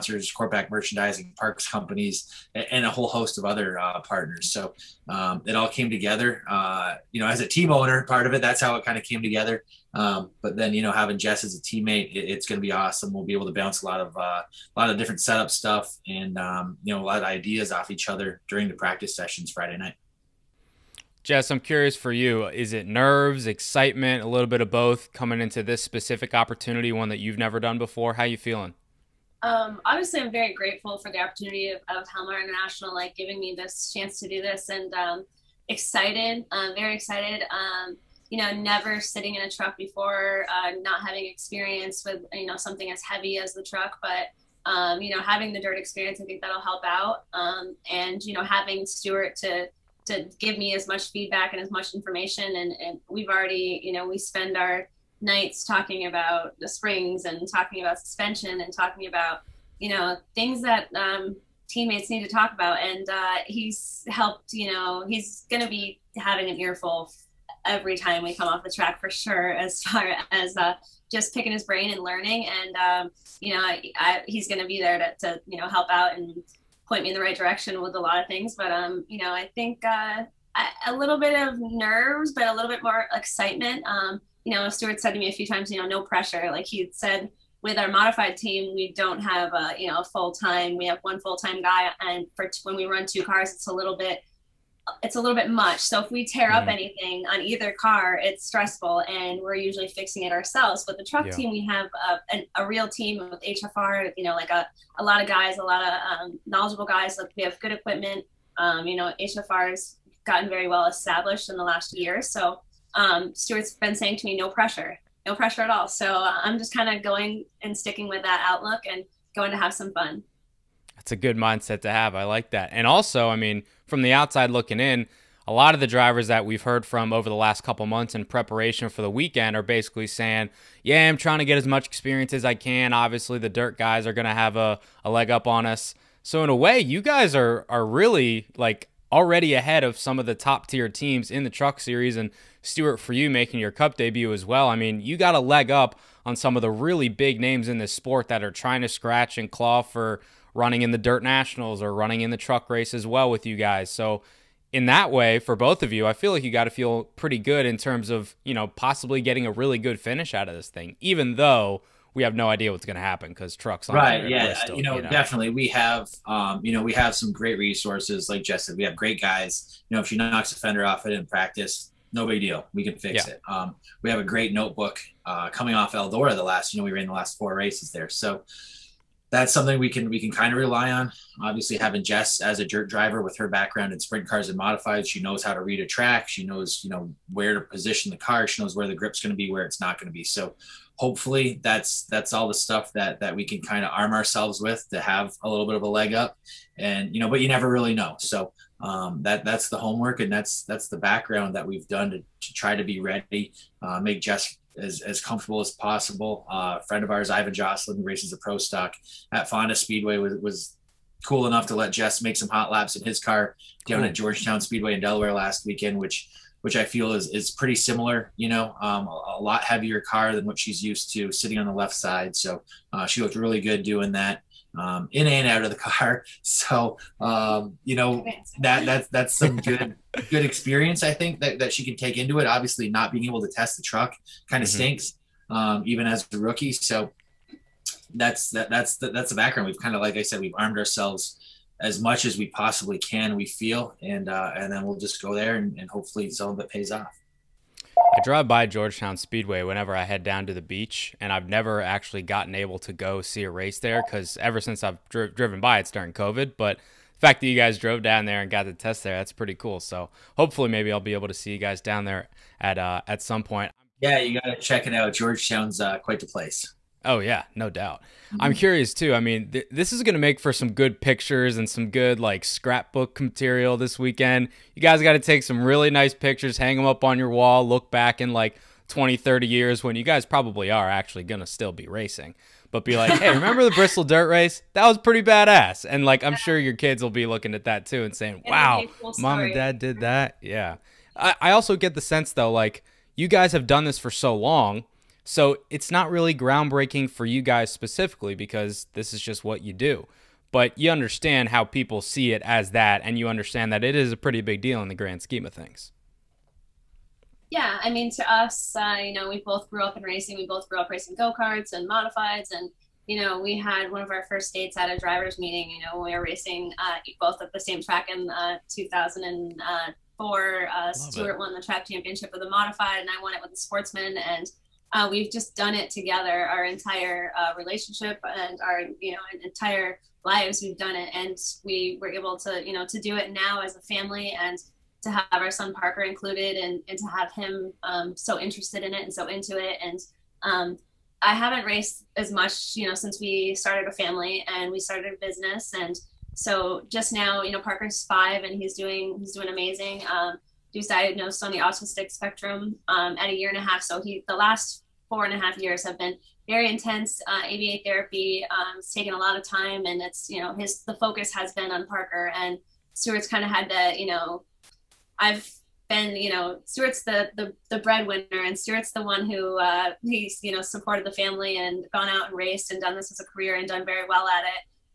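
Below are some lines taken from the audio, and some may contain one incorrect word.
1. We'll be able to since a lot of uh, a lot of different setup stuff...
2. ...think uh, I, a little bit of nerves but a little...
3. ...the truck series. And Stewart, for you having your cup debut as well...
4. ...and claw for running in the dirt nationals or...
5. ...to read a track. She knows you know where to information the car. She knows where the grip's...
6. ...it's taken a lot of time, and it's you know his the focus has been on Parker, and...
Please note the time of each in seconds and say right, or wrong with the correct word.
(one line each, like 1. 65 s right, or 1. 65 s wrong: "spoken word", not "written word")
1. 13 s wrong: "bounce", not "since"
2. 79 s right
3. 141 s wrong: "making", not "having"
4. 149 s right
5. 185 s wrong: "position", not "information"
6. 358 s right.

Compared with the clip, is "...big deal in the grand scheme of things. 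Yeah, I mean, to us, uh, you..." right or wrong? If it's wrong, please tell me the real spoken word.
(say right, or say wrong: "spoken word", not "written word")
right.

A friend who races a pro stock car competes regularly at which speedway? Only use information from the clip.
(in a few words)
Fonda Speedway.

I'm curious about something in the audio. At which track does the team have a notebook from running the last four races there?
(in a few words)
Eldora.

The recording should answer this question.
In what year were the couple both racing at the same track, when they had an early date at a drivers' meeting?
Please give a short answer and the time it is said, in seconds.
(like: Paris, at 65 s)
2004, at 318 s.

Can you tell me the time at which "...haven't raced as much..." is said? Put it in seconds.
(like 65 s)
341 s.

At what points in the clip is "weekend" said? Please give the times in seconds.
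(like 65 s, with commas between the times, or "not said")
129 s, 215 s, 273 s.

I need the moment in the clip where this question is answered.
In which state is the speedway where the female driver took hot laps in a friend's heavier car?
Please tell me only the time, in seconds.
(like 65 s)
215 s.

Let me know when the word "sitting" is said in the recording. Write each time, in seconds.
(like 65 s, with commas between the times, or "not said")
38 s, 221 s.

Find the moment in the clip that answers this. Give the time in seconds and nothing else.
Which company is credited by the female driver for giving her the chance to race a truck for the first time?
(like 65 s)
32 s.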